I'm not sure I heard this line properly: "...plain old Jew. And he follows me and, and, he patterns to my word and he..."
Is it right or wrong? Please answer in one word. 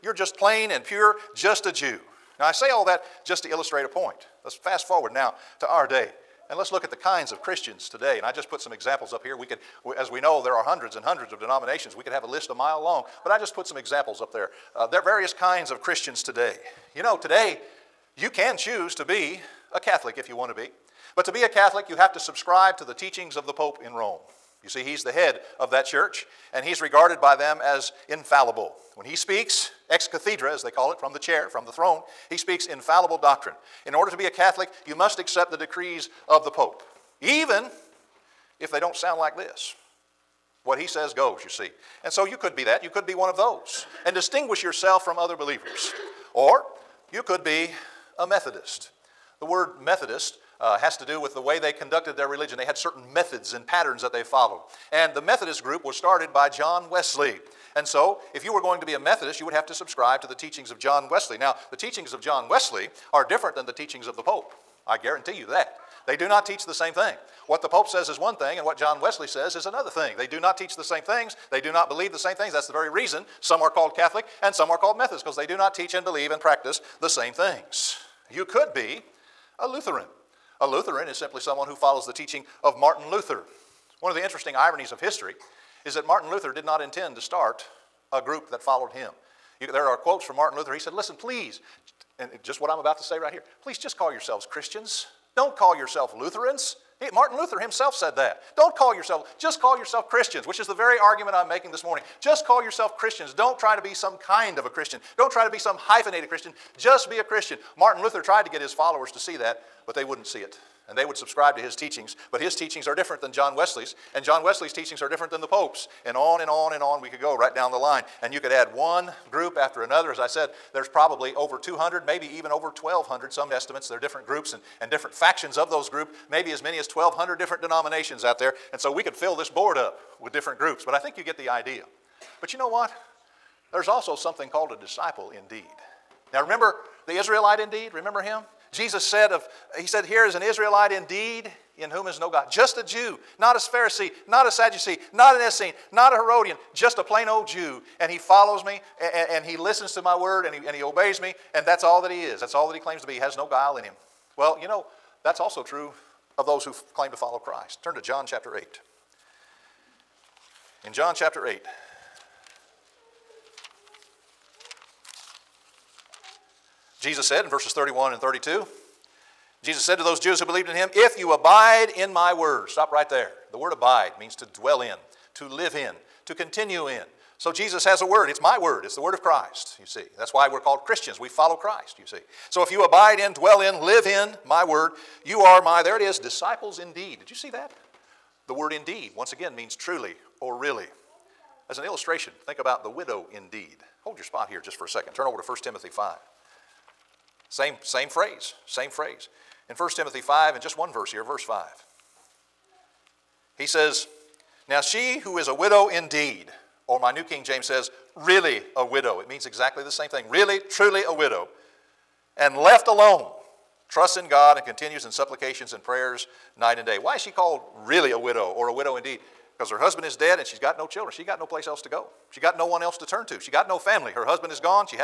wrong.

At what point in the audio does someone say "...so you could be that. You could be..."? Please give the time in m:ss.
0:42.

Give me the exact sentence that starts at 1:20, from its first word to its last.
A Lutheran is simply someone who follows the teaching of Martin Luther.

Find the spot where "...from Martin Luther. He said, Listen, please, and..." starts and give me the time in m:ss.
1:30.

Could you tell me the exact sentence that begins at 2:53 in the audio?
The word abide means to dwell in, to live in, to continue in.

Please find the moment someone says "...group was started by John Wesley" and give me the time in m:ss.
0:55.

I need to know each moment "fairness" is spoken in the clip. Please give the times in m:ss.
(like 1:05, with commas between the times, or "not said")
not said.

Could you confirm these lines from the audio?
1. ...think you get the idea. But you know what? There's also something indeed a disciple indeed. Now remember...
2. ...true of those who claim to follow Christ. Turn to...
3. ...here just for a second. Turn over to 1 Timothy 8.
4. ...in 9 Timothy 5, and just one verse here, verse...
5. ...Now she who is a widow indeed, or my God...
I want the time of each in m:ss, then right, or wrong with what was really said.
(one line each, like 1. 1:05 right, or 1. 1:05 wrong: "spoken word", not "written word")
1. 2:10 wrong: "called", not "indeed"
2. 2:35 right
3. 3:14 wrong: "5", not "8"
4. 3:19 wrong: "1", not "9"
5. 3:24 wrong: "New", not "God".